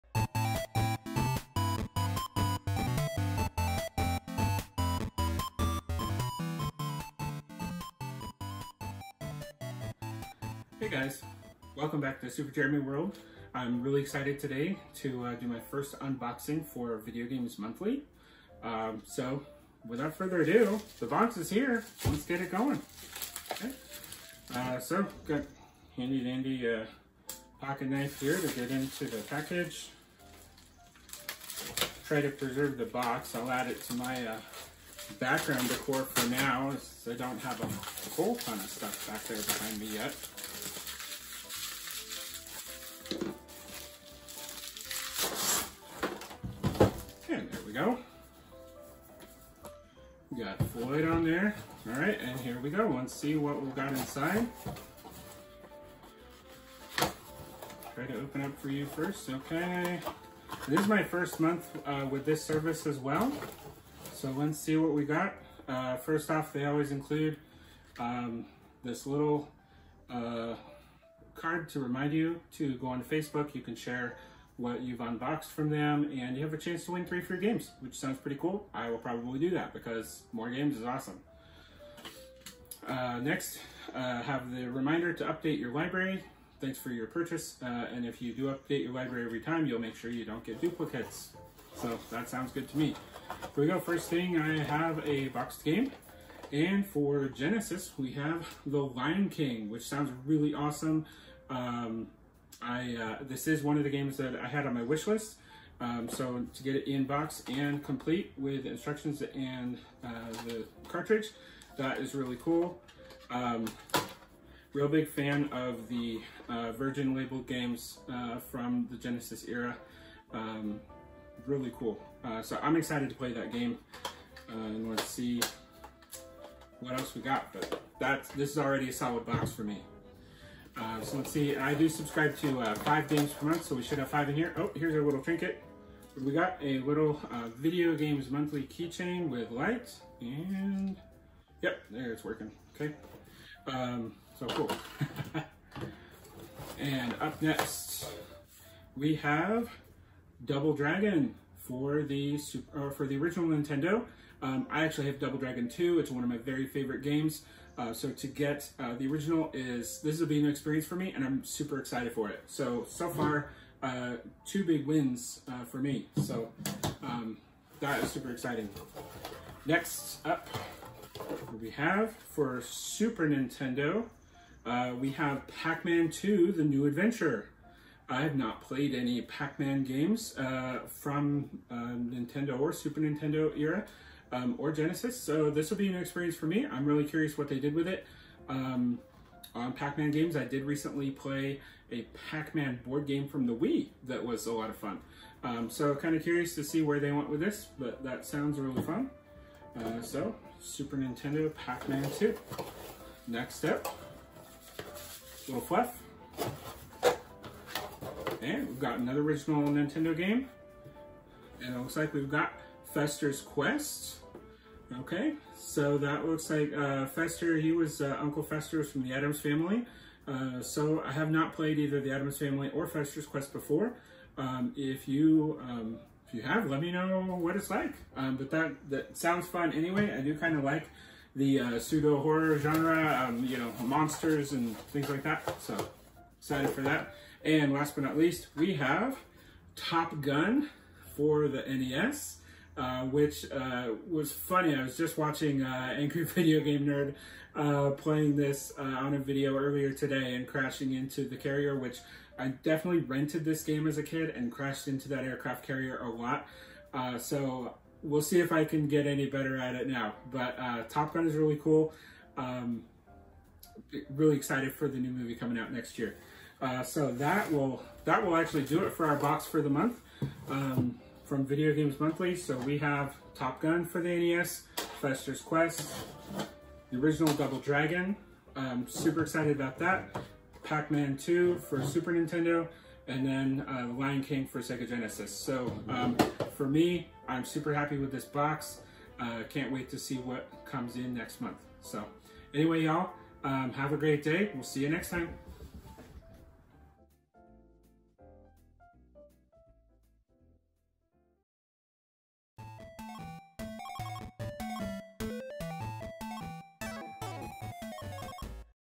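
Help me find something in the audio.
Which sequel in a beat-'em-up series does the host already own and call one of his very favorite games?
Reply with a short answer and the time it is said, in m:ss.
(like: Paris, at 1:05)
Double Dragon 2, at 2:35.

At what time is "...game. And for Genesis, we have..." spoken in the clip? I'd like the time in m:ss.
1:35.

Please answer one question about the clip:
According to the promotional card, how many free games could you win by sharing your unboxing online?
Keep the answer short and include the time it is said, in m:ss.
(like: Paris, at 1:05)
3, at 1:17.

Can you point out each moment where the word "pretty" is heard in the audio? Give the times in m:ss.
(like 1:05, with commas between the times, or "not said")
1:18.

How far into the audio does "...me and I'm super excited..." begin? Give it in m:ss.
2:40.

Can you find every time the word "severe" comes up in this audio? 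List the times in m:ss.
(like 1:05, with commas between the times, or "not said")
not said.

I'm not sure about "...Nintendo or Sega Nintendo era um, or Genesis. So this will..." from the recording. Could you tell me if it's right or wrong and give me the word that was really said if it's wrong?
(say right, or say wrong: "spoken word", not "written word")
wrong: "Super", not "Sega".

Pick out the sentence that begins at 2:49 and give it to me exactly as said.
Next up, we have for Super Nintendo, uh, we have Pac-Man 2, The New Adventure.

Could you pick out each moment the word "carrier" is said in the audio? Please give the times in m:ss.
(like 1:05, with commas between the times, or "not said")
4:11, 4:15.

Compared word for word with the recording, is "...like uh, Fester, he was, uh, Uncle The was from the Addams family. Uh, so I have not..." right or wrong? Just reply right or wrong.
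wrong.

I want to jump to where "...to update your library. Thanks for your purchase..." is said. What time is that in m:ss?
1:25.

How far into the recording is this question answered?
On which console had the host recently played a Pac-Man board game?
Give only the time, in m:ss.
3:13.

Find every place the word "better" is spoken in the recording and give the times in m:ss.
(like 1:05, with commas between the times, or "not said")
4:19.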